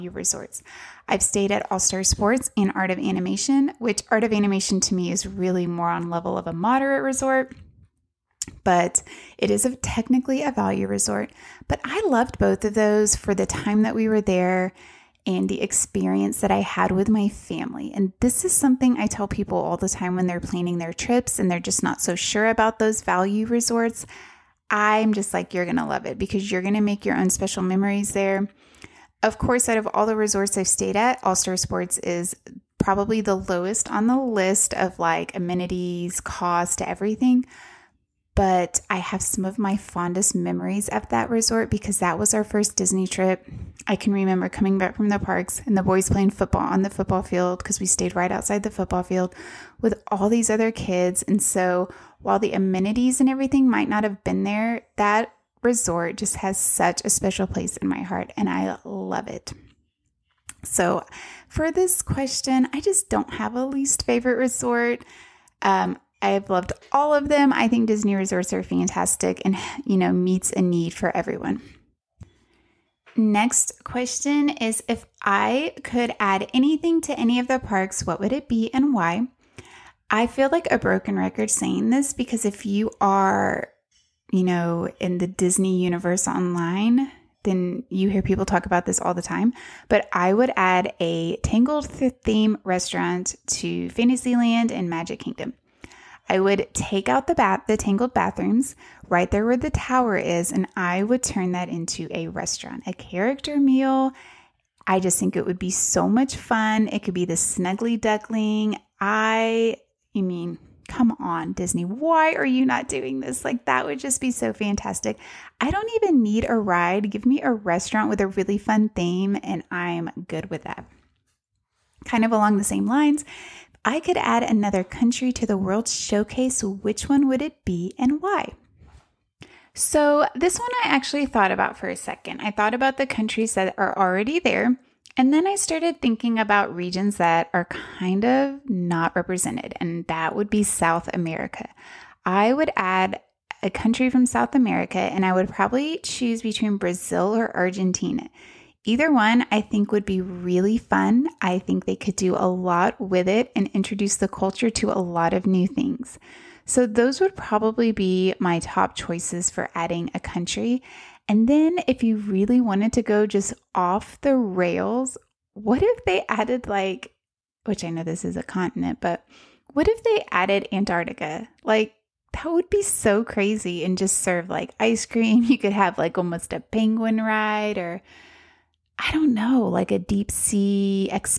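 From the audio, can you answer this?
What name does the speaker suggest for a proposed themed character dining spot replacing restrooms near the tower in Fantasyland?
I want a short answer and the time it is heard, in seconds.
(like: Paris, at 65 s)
Snuggly Duckling, at 107 s.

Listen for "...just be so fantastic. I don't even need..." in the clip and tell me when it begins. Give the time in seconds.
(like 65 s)
113 s.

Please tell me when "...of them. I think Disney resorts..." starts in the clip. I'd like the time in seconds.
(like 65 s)
67 s.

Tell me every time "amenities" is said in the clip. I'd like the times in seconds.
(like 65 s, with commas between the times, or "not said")
35 s, 52 s.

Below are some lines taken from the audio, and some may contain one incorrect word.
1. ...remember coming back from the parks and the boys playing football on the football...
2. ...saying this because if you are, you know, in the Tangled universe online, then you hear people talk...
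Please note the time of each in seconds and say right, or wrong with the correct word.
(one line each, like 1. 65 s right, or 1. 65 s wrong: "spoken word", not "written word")
1. 44 s right
2. 81 s wrong: "Disney", not "Tangled".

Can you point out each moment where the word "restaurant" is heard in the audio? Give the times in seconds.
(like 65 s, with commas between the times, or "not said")
92 s, 102 s, 117 s.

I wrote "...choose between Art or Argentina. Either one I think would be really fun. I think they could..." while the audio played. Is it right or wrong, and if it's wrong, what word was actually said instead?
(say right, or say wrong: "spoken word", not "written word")
wrong: "Brazil", not "Art".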